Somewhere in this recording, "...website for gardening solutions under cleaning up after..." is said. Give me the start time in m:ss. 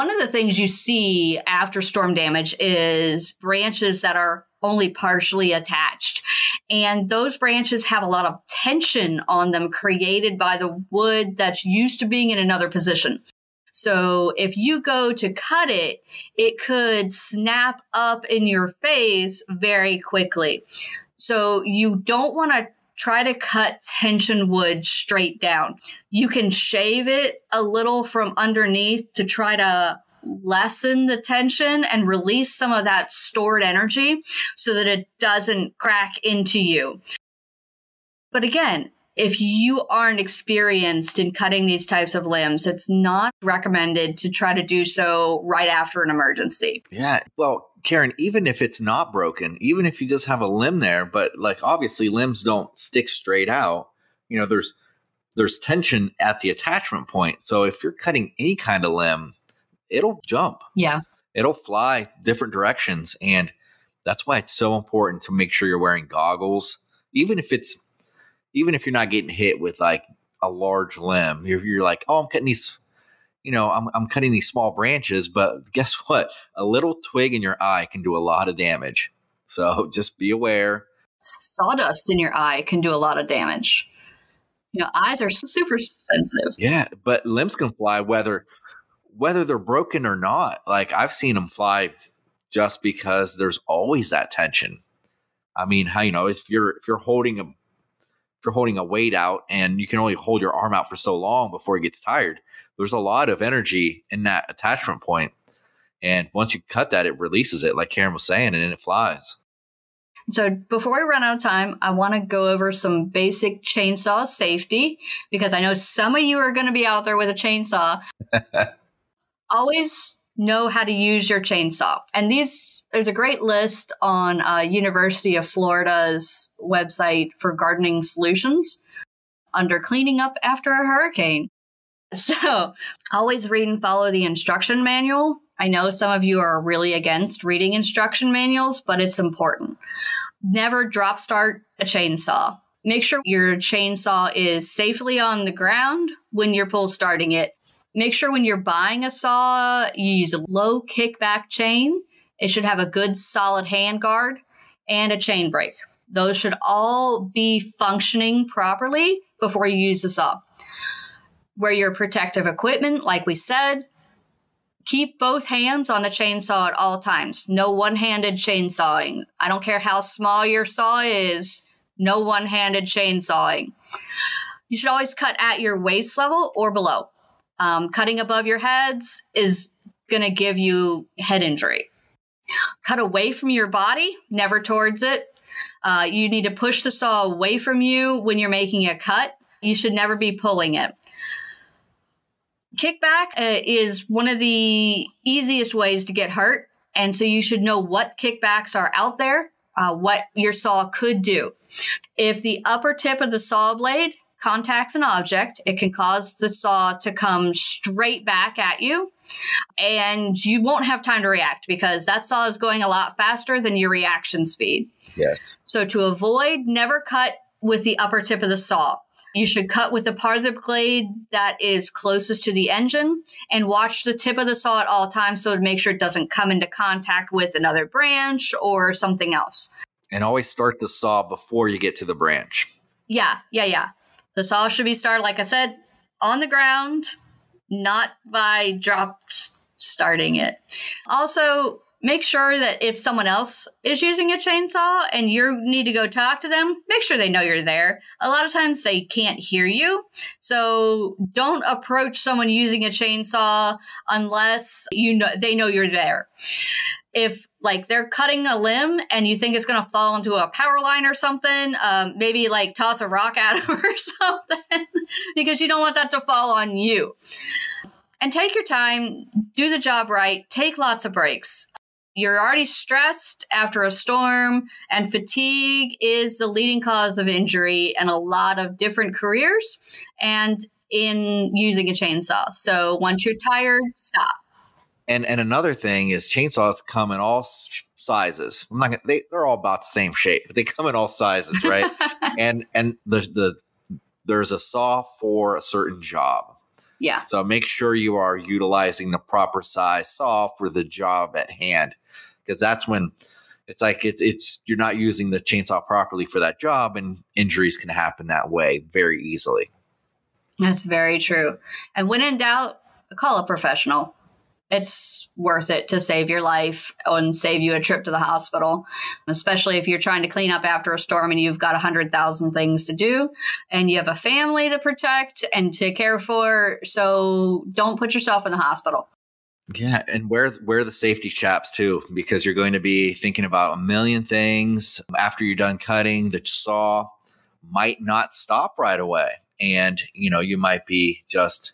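2:06.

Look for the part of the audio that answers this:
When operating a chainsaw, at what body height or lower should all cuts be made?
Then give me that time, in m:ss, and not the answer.
2:55.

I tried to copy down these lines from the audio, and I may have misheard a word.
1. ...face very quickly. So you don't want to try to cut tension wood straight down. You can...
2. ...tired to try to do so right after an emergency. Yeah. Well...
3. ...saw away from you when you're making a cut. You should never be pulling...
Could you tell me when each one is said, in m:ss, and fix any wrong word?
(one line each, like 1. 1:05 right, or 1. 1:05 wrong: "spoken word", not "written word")
1. 0:18 right
2. 0:43 wrong: "recommended", not "tired"
3. 3:06 right.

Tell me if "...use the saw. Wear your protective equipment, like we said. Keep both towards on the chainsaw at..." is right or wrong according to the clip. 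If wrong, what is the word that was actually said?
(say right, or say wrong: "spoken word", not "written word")
wrong: "hands", not "towards".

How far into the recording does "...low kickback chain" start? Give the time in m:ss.
2:30.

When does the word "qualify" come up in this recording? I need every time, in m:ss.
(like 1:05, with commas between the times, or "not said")
not said.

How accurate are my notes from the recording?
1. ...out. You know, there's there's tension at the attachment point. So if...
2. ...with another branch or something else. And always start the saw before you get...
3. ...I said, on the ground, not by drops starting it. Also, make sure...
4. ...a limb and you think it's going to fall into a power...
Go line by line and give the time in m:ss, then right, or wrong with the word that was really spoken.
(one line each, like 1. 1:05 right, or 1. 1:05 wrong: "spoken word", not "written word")
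1. 0:53 right
2. 3:47 right
3. 3:55 right
4. 4:18 right.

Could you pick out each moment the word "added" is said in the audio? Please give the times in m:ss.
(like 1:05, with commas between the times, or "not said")
not said.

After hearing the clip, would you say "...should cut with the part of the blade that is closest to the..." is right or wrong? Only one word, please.
right.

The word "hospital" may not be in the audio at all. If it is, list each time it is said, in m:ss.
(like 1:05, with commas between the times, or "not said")
5:18, 5:28.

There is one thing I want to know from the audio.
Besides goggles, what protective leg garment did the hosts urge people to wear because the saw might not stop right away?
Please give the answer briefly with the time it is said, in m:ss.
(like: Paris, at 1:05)
Safety chaps, at 5:30.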